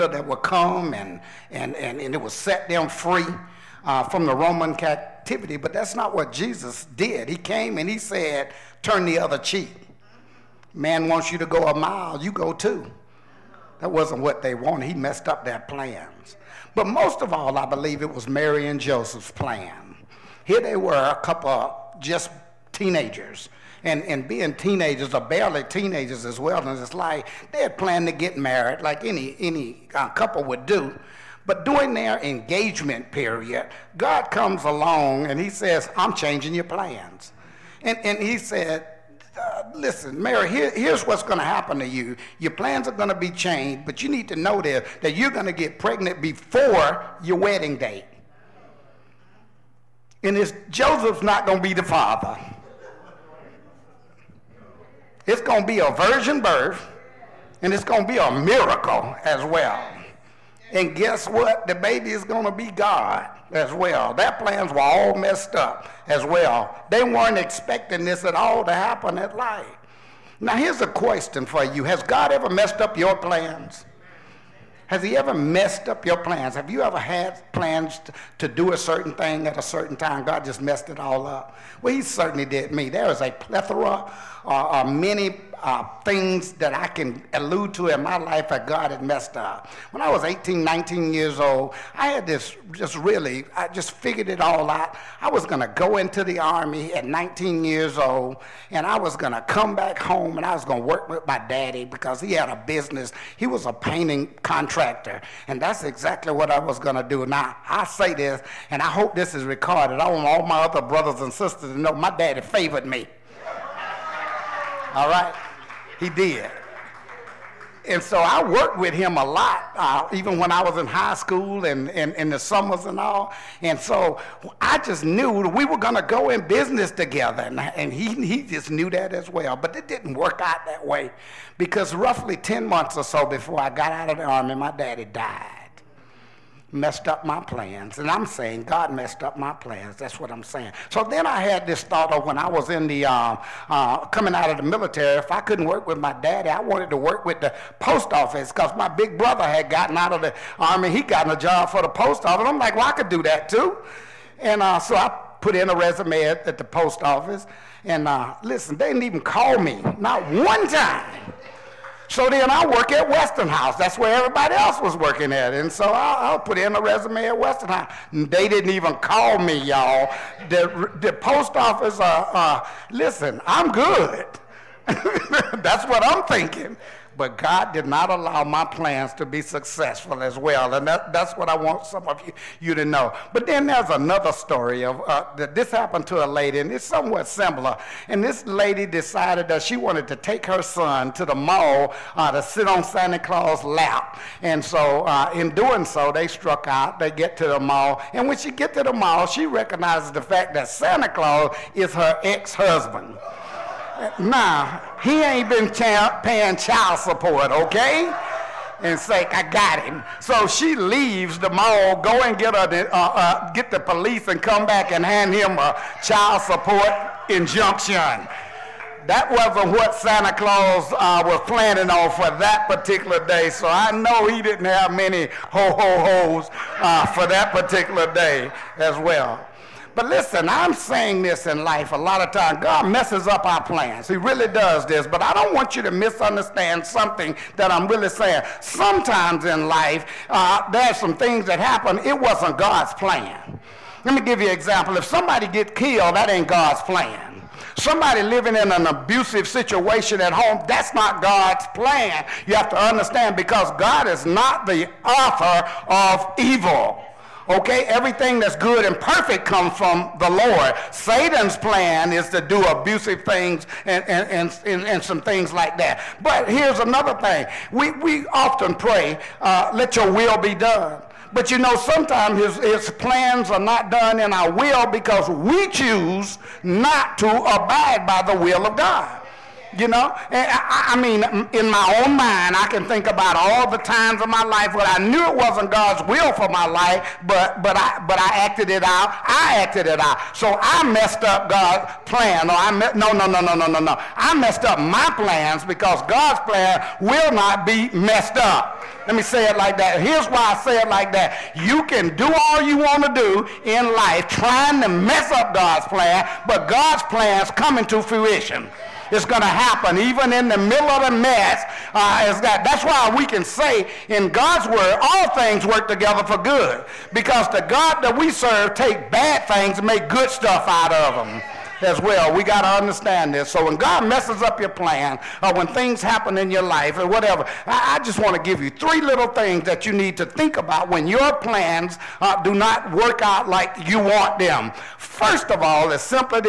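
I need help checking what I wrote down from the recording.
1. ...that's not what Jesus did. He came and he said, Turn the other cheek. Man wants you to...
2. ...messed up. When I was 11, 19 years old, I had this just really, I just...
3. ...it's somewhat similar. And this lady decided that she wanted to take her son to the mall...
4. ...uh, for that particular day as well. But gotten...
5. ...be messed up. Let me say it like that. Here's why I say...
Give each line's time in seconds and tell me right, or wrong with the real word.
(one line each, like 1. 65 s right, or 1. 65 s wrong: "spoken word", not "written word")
1. 5 s right
2. 89 s wrong: "18", not "11"
3. 186 s right
4. 226 s wrong: "listen", not "gotten"
5. 297 s right.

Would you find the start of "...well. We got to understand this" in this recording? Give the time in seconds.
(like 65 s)
322 s.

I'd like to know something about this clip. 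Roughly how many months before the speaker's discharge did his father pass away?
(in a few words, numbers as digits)
10.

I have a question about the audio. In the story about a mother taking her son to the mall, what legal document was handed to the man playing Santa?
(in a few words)
Child support injunction.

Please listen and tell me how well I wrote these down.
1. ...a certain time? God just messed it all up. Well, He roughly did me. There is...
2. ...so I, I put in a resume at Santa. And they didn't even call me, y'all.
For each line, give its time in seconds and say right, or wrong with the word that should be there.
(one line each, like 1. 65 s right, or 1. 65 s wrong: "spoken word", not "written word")
1. 79 s wrong: "certainly", not "roughly"
2. 165 s wrong: "Westinghouse", not "Santa".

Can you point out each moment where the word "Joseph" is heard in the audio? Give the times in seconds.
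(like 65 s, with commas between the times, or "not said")
18 s, 50 s.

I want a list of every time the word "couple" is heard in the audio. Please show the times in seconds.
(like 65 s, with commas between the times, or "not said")
21 s, 30 s.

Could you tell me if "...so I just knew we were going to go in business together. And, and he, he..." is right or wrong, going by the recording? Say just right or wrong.
right.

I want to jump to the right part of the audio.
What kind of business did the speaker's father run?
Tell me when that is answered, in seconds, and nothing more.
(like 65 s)
103 s.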